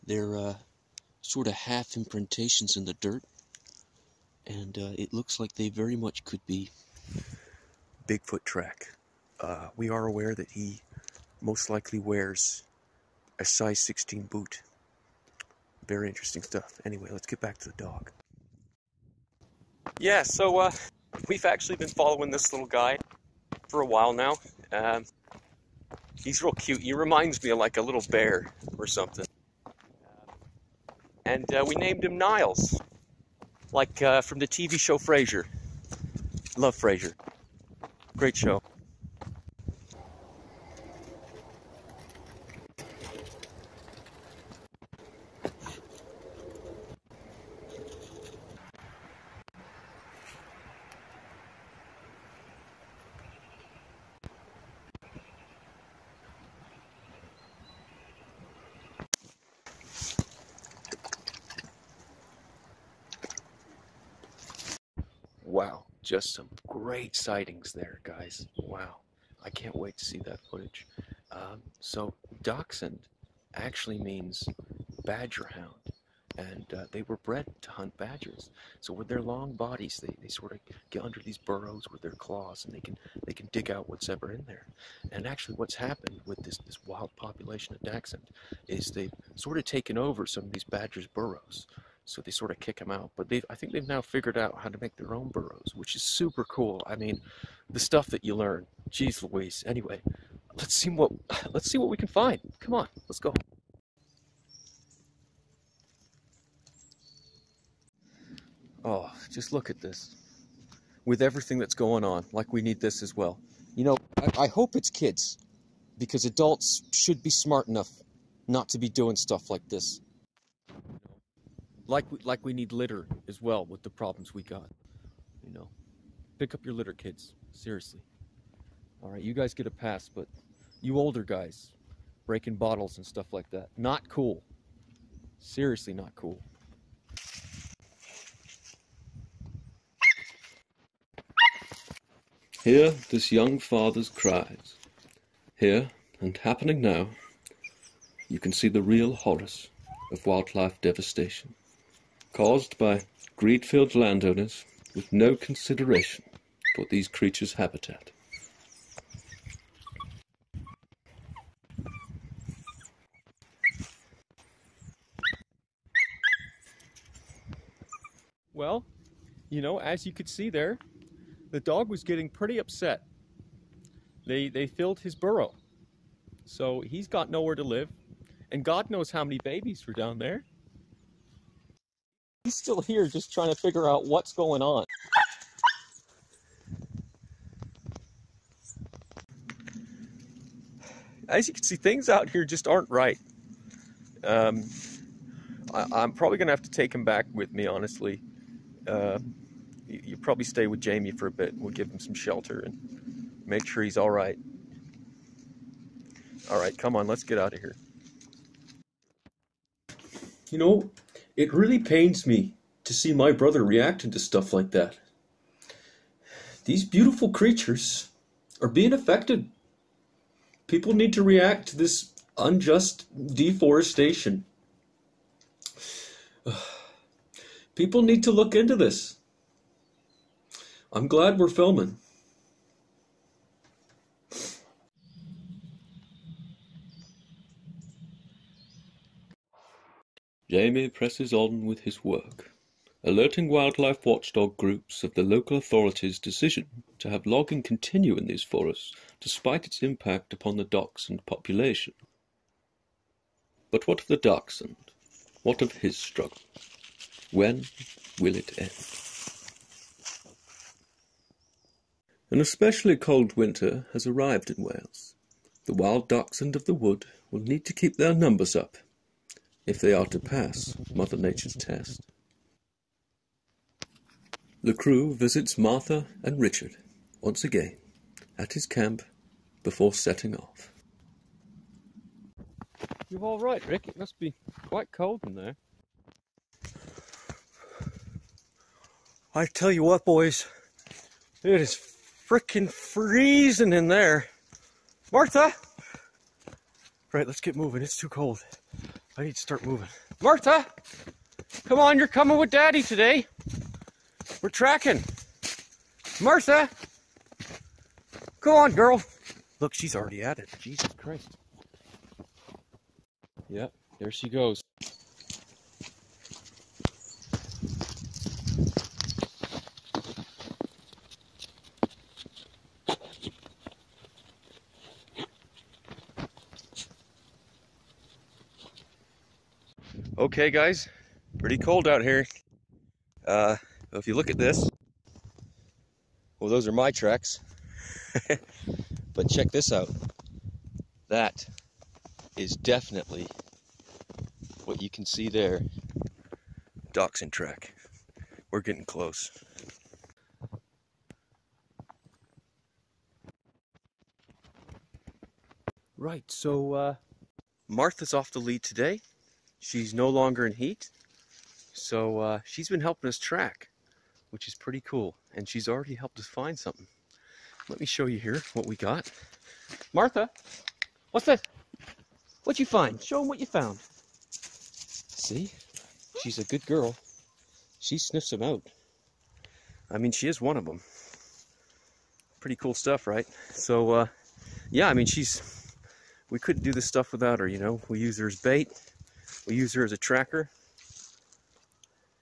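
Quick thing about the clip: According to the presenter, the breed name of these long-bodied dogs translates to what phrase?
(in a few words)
badger hound.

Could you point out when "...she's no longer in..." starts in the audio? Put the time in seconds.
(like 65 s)
359 s.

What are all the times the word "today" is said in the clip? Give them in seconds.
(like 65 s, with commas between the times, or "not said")
302 s, 358 s.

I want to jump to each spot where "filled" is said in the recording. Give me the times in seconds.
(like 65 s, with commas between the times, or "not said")
153 s, 174 s.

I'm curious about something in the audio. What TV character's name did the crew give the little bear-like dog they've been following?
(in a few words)
Niles.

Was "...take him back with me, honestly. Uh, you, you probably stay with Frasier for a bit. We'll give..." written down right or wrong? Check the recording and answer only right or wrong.
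wrong.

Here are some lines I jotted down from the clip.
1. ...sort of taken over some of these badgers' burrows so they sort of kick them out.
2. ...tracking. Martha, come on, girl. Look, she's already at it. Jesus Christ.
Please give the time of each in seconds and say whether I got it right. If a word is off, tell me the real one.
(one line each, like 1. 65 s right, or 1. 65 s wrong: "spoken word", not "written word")
1. 89 s right
2. 304 s right.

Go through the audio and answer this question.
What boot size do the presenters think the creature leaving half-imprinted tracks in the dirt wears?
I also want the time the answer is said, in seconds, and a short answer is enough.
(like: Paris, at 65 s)
16, at 13 s.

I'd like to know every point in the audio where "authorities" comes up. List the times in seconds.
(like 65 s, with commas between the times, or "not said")
245 s.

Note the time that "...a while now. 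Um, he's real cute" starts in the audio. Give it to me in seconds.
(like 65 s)
23 s.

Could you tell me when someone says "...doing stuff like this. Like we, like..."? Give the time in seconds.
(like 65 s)
118 s.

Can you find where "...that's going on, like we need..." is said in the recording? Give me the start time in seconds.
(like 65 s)
111 s.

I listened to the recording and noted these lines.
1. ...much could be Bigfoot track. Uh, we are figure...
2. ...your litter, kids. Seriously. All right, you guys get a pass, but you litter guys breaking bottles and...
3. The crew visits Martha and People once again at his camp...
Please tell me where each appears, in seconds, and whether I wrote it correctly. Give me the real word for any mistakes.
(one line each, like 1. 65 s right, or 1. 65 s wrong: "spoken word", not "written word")
1. 5 s wrong: "aware", not "figure"
2. 126 s wrong: "older", not "litter"
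3. 274 s wrong: "Richard", not "People".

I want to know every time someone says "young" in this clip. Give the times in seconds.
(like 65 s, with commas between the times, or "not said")
143 s.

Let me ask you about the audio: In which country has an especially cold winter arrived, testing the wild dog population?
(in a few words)
Wales.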